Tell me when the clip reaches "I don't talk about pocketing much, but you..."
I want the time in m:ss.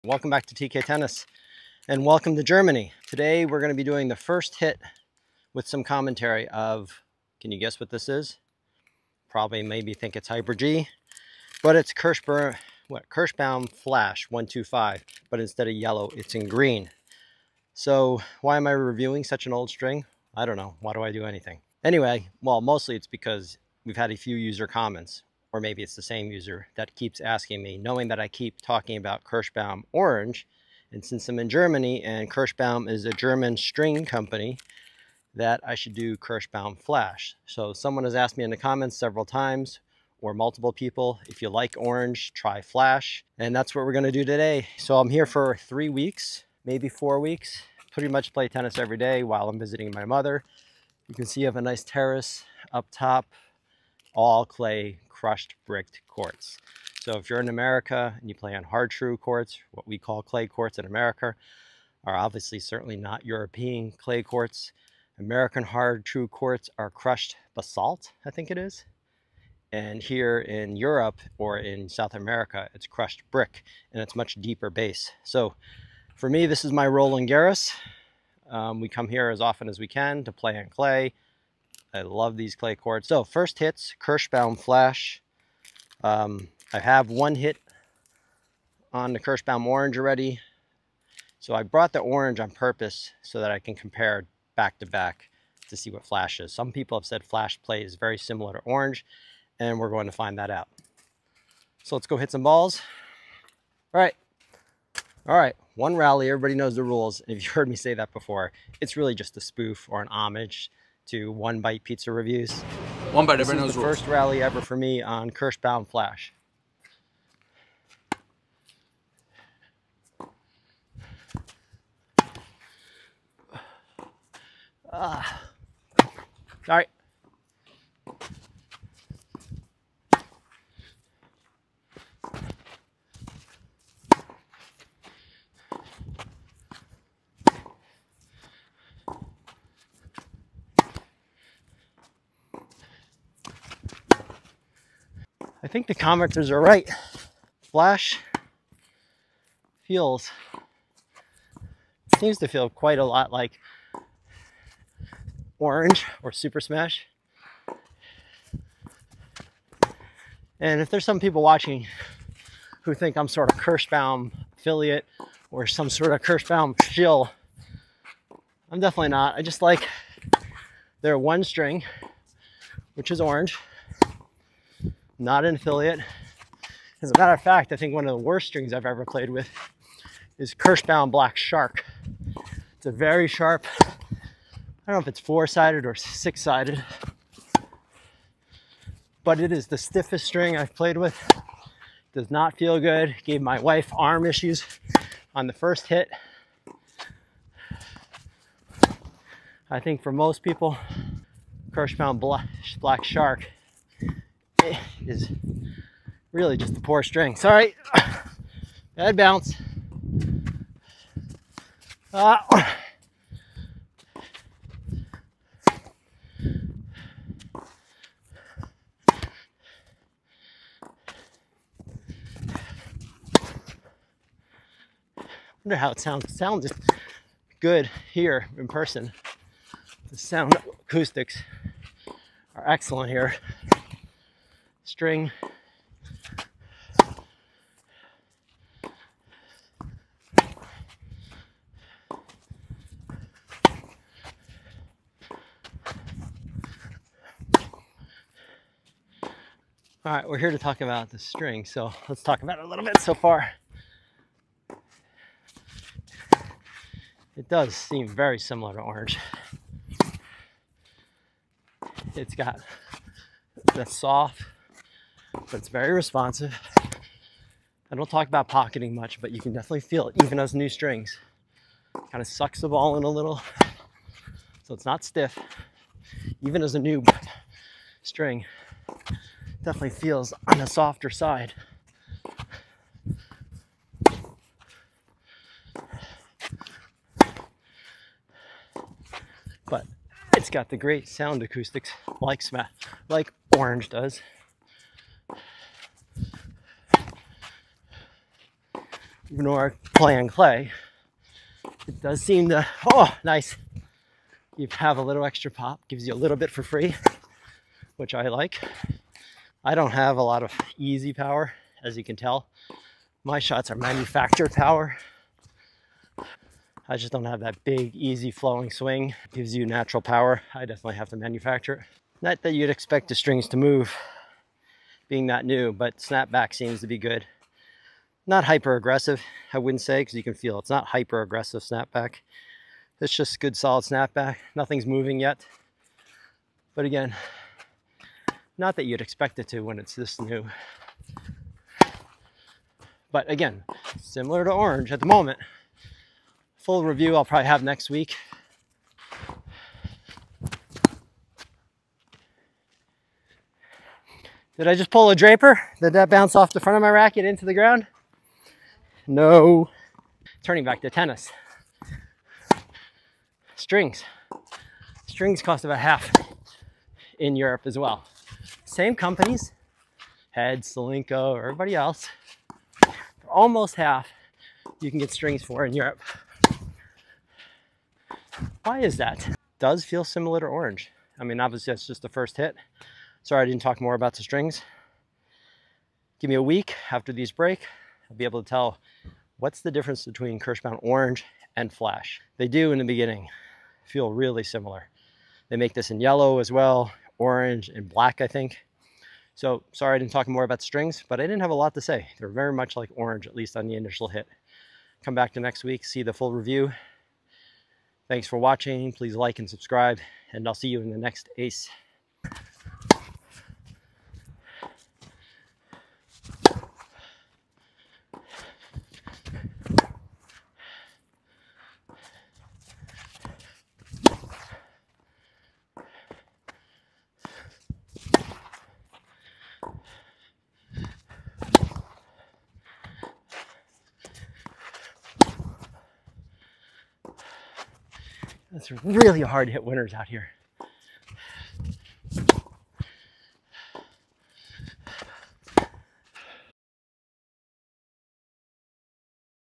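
4:27.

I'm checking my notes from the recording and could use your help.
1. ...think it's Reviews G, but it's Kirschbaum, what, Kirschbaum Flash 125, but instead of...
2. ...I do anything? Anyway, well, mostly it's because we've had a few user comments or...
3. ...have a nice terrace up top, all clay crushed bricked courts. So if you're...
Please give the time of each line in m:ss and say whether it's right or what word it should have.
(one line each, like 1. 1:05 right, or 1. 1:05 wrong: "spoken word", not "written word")
1. 0:09 wrong: "Hyper", not "Reviews"
2. 0:21 right
3. 0:51 right.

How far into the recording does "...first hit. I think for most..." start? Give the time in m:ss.
3:15.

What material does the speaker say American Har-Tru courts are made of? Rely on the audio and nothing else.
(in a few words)
crushed basalt.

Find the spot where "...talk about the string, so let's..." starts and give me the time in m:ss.
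4:10.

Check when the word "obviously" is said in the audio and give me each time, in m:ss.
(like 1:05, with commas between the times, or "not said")
1:02, 6:21.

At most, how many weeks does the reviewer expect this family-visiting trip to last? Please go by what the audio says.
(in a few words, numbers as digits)
4.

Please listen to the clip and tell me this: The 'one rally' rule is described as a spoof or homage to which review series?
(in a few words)
One Bite Pizza Reviews.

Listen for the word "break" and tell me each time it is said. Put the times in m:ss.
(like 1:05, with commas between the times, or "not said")
6:27.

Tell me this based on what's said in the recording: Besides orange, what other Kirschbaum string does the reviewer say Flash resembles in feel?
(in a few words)
Super Smash.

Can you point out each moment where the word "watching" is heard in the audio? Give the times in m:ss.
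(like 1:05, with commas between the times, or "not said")
2:41, 6:48.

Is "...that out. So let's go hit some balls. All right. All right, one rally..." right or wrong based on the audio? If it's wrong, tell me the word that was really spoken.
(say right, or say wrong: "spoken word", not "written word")
right.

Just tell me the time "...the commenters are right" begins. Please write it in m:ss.
2:25.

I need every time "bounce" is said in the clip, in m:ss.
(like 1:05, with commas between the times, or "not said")
3:29, 5:56.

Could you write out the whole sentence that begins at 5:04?
You have a little extra pop, gives you a little bit for free, which I like.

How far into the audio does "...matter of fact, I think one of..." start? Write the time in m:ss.
2:57.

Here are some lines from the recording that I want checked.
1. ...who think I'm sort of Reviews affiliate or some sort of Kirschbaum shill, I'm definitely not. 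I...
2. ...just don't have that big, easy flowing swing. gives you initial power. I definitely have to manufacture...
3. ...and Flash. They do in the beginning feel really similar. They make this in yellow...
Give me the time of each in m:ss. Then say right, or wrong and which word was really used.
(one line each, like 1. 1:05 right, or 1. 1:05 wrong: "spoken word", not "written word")
1. 2:42 wrong: "Kirschbaum", not "Reviews"
2. 5:16 wrong: "natural", not "initial"
3. 6:31 right.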